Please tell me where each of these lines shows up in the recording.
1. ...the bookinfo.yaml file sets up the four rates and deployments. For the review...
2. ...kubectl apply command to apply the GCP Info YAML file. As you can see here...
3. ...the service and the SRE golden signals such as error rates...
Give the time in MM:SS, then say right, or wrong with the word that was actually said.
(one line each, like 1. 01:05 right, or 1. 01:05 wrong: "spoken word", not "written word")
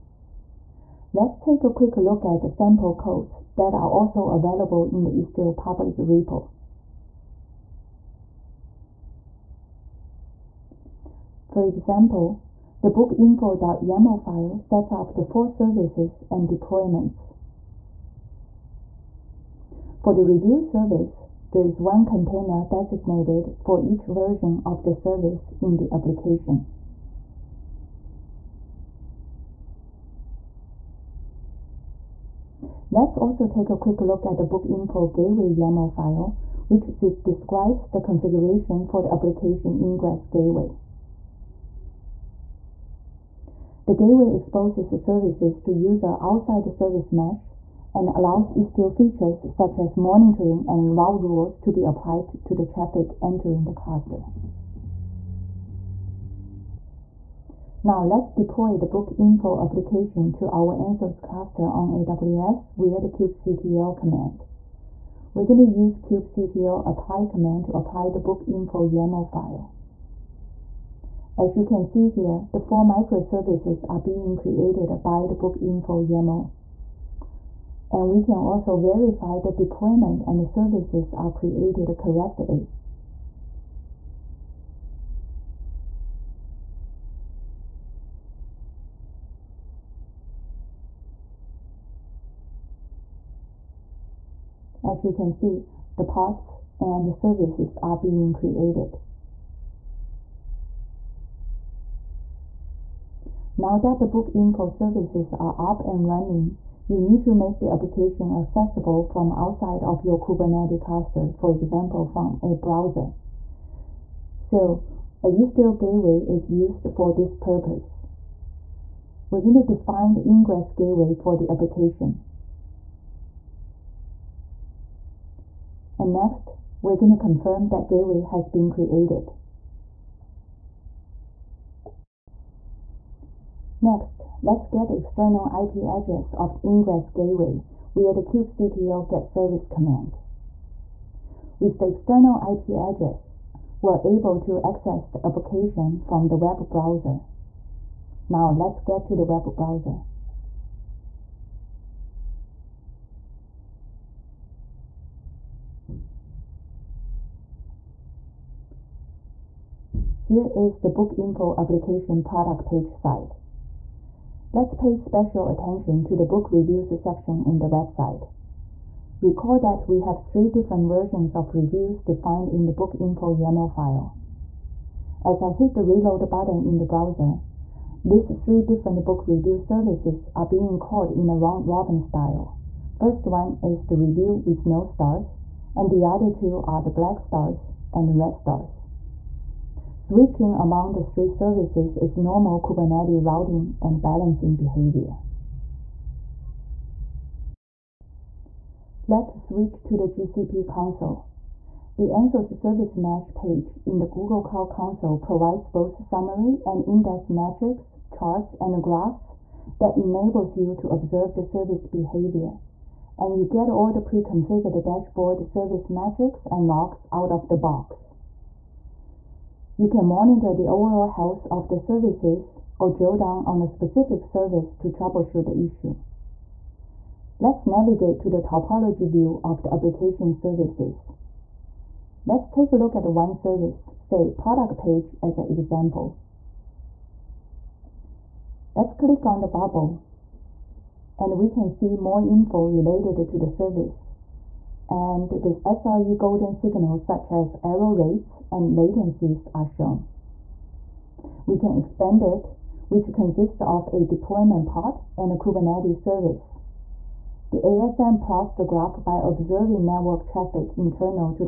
1. 00:12 wrong: "services", not "rates"
2. 01:05 wrong: "Book", not "GCP"
3. 04:03 right.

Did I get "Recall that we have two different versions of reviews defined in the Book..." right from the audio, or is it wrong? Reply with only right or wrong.
wrong.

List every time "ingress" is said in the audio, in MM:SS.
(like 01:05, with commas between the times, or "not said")
00:39, 02:00, 02:16.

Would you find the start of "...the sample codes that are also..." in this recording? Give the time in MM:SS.
00:02.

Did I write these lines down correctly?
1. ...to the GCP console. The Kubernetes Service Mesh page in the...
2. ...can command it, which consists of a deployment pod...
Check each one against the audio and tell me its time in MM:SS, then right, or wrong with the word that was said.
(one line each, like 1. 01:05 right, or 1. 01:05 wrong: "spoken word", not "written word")
1. 03:19 wrong: "Anthos", not "Kubernetes"
2. 04:11 wrong: "expand", not "command".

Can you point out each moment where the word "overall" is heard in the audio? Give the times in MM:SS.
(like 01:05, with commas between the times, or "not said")
03:40.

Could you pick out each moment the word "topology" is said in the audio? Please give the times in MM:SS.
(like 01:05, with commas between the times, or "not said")
03:48.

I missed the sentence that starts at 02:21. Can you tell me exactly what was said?
With the external IP address, we're able to access the application from the web browser.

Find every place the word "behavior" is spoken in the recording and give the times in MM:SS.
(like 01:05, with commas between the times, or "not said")
03:14, 03:31.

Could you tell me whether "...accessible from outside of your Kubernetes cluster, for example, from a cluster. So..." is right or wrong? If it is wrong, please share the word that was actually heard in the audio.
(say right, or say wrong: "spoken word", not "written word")
wrong: "browser", not "cluster".